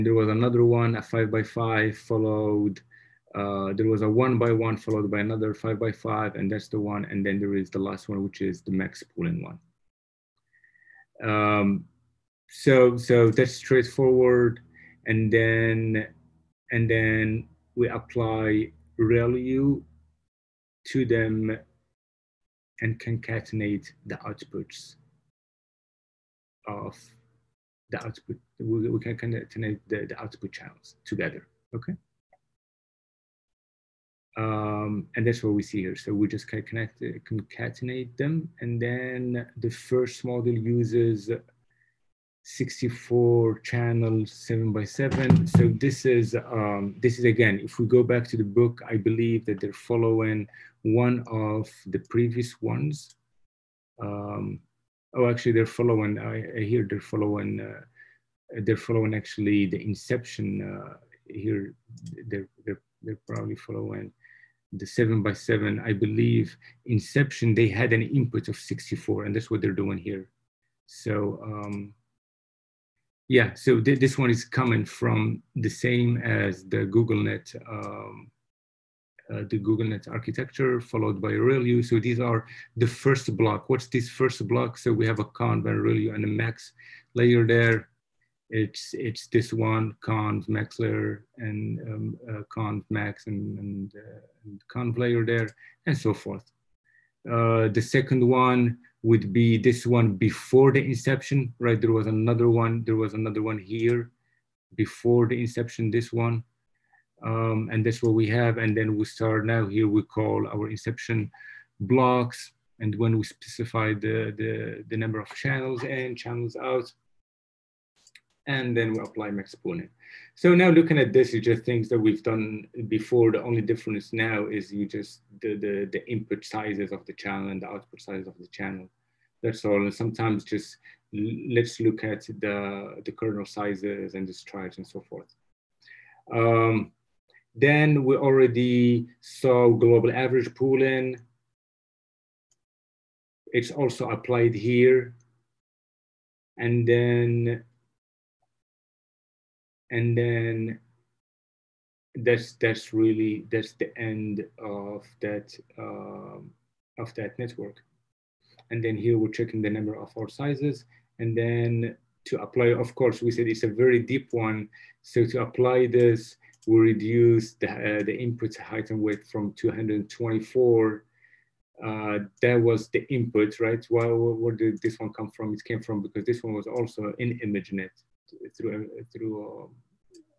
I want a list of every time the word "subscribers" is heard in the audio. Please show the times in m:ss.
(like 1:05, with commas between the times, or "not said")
not said.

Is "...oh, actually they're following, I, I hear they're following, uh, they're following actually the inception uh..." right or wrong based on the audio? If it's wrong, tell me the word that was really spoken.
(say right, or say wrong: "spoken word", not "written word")
right.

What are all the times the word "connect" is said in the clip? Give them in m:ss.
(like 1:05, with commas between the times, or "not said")
0:29, 0:36.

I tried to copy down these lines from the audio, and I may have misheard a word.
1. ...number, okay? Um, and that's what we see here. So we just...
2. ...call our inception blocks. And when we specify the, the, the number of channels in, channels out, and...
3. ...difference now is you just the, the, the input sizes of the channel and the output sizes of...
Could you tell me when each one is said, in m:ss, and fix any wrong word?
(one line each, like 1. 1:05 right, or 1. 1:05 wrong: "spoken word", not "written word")
1. 0:31 wrong: "together", not "number"
2. 1:50 right
3. 2:03 right.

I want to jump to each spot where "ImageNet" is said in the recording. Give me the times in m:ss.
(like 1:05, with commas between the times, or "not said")
2:57.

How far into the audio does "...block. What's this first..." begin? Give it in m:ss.
1:23.